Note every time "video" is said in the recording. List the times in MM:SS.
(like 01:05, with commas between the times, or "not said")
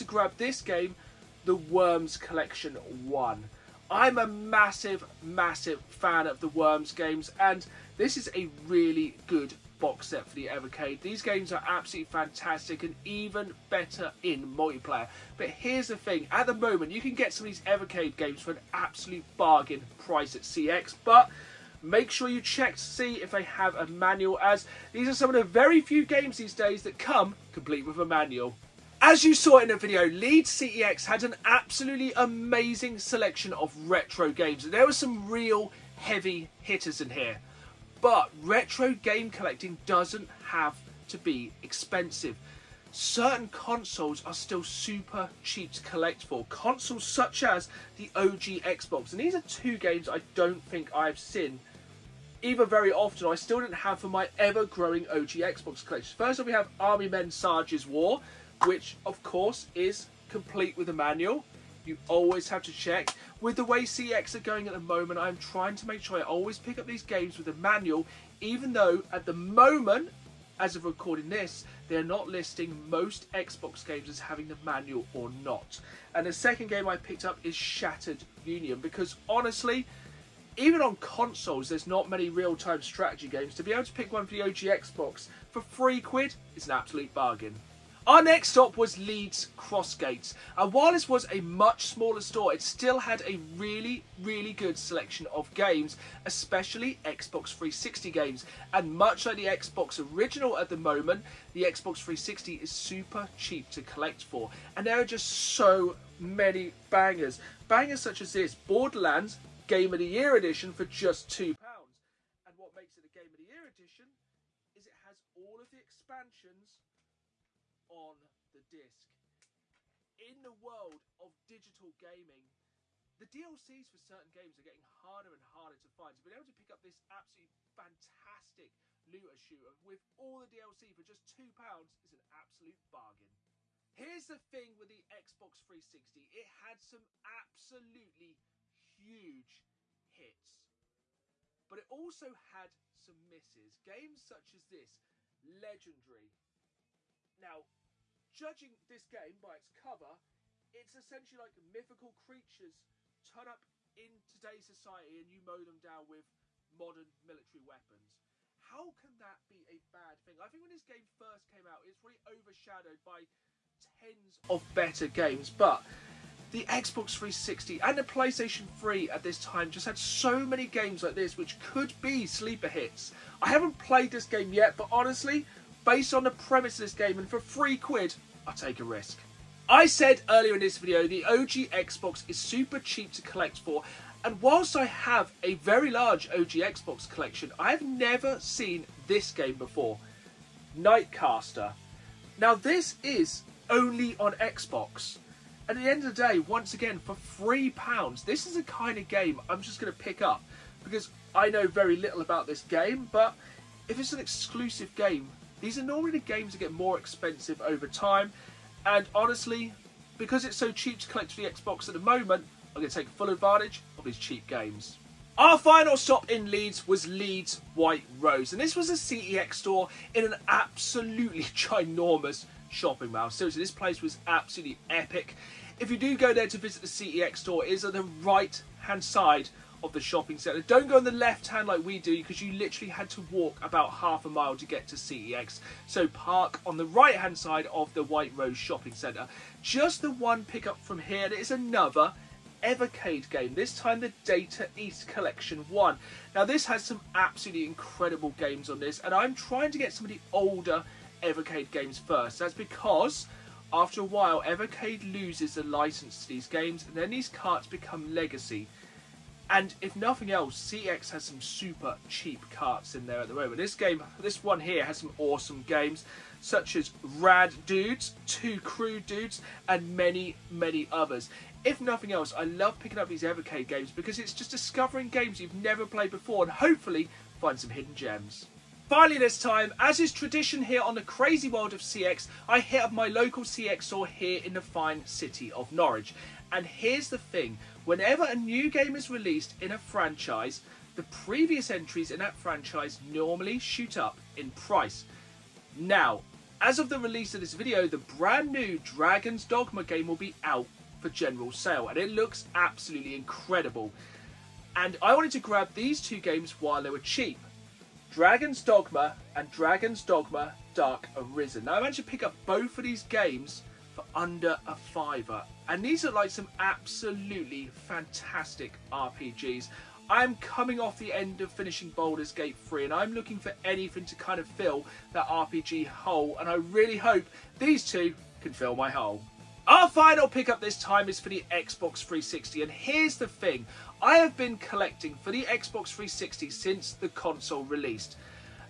00:29, 03:00, 04:57.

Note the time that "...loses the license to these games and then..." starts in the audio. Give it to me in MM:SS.
04:15.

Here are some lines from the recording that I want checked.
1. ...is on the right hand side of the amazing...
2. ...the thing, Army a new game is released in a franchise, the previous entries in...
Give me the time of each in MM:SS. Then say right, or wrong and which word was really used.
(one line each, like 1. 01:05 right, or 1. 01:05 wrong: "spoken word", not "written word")
1. 03:47 wrong: "shopping", not "amazing"
2. 04:47 wrong: "Whenever", not "Army".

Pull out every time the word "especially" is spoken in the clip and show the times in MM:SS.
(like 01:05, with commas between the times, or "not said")
01:36.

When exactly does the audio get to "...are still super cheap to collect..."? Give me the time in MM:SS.
00:44.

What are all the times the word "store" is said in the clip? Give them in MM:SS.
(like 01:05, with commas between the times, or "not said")
01:32, 03:39, 03:47, 04:43.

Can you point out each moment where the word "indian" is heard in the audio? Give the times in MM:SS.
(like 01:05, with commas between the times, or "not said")
not said.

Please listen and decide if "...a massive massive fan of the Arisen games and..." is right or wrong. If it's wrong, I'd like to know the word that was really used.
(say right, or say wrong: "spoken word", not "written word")
wrong: "Worms", not "Arisen".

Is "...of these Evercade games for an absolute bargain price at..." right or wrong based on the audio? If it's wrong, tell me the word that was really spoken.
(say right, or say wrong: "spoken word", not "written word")
right.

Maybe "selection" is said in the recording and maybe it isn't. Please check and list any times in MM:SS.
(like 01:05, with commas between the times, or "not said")
00:32, 01:34.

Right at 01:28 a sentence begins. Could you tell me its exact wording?
Our next stop was Leeds Crossgates.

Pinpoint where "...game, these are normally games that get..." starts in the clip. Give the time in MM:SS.
03:24.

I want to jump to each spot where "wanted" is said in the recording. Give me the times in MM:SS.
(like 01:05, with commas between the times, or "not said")
05:05.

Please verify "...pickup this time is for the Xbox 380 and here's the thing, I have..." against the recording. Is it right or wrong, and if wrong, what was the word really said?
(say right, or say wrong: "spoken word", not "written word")
wrong: "360", not "380".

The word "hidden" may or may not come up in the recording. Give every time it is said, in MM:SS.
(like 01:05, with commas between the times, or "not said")
04:37.